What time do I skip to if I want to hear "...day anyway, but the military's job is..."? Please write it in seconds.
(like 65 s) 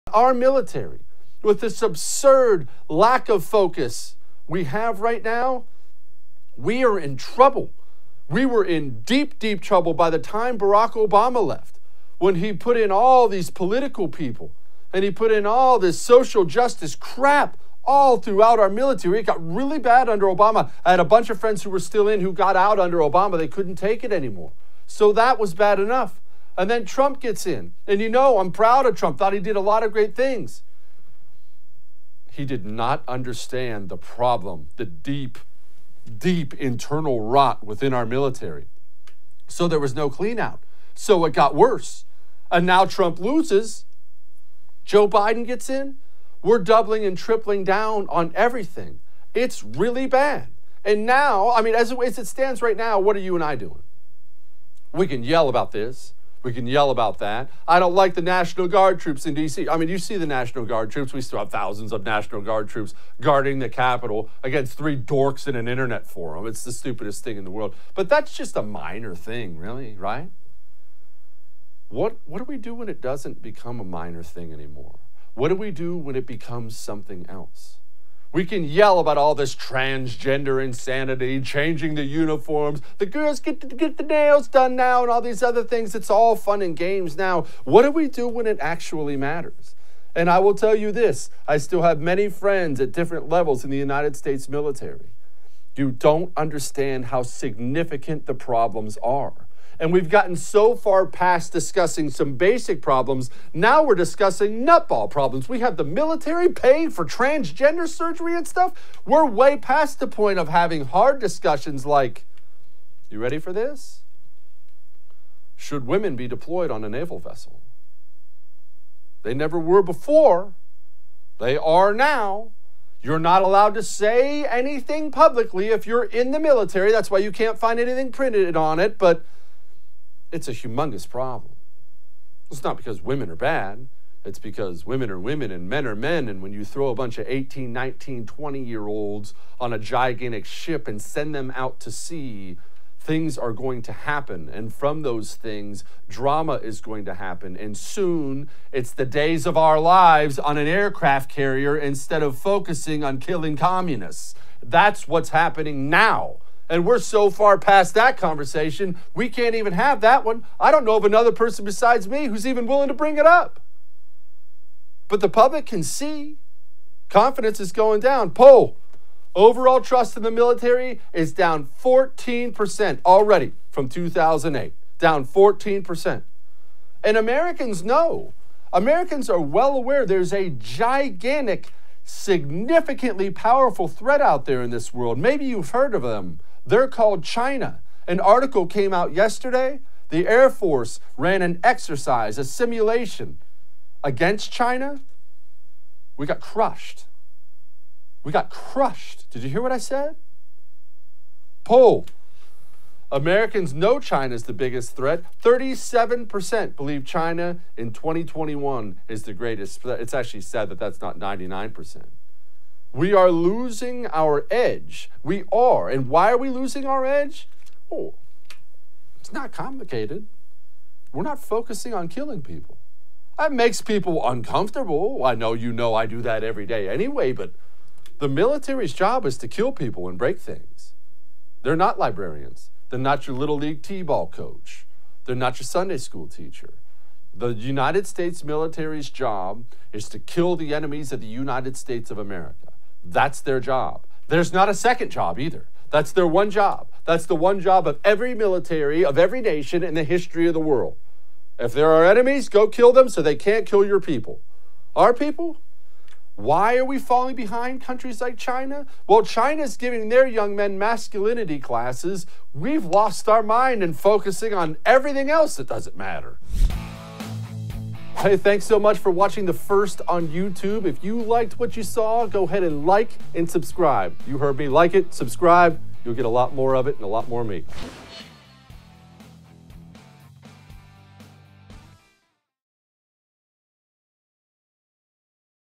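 226 s.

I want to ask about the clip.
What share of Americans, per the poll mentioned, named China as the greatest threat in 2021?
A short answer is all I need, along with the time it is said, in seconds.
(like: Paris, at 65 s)
37%, at 205 s.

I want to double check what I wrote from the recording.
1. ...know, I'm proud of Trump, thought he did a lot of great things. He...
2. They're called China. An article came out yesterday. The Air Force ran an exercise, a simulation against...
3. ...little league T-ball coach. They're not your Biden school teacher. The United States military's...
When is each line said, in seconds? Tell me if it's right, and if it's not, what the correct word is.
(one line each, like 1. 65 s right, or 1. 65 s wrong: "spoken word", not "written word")
1. 28 s right
2. 186 s right
3. 233 s wrong: "Sunday", not "Biden".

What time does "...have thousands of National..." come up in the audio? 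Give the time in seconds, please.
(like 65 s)
61 s.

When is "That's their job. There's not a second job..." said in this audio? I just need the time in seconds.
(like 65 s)
243 s.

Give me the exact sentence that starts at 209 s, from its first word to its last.
It's actually sad that that's not 99%.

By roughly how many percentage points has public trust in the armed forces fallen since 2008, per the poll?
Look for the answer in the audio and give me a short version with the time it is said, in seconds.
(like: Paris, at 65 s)
14%, at 171 s.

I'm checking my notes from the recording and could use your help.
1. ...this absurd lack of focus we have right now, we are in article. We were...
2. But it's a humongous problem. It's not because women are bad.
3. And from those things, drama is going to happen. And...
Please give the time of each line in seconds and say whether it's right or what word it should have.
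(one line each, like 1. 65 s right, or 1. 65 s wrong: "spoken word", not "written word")
1. 1 s wrong: "trouble", not "article"
2. 128 s right
3. 144 s right.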